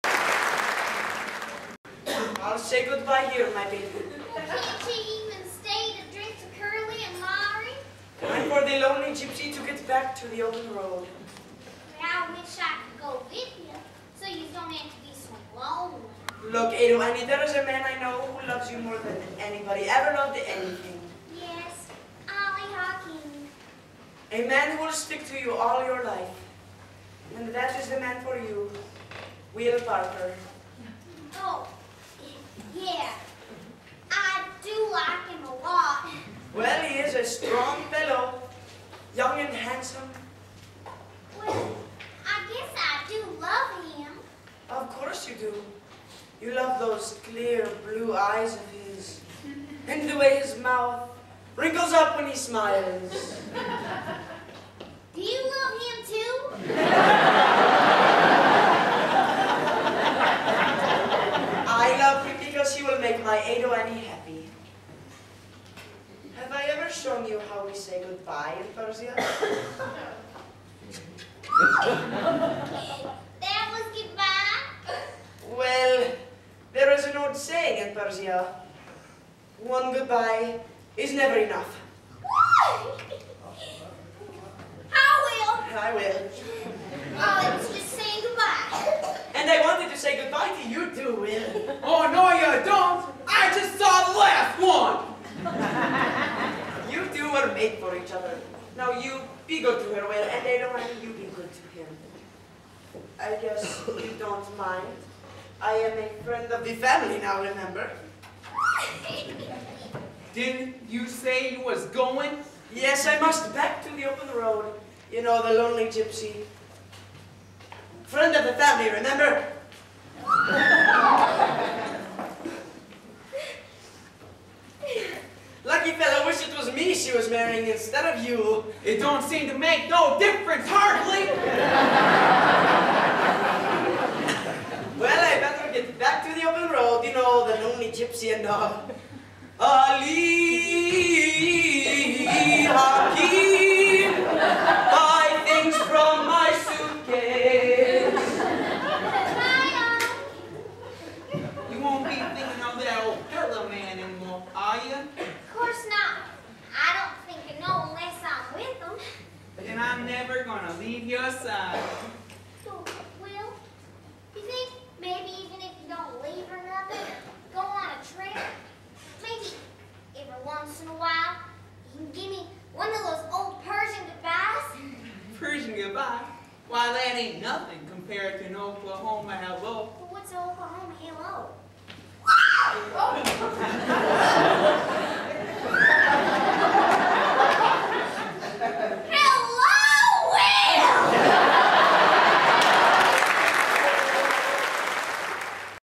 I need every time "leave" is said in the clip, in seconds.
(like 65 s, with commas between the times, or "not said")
160 s, 166 s.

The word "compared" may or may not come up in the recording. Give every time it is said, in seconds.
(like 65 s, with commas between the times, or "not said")
177 s.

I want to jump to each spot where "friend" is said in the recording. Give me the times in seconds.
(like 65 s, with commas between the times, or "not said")
106 s, 118 s.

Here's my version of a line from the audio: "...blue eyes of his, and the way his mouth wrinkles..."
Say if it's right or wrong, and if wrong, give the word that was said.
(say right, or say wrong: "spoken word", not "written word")
right.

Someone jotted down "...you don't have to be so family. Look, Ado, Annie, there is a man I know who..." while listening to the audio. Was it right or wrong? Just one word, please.
wrong.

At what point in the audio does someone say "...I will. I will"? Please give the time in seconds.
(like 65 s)
84 s.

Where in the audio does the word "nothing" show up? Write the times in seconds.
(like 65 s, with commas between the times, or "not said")
166 s, 177 s.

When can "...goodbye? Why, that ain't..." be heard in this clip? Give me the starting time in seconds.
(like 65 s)
175 s.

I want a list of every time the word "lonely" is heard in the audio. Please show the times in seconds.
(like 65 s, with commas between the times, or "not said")
8 s, 15 s, 115 s, 137 s.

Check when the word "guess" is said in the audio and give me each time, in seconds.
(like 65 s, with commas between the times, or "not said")
42 s, 103 s.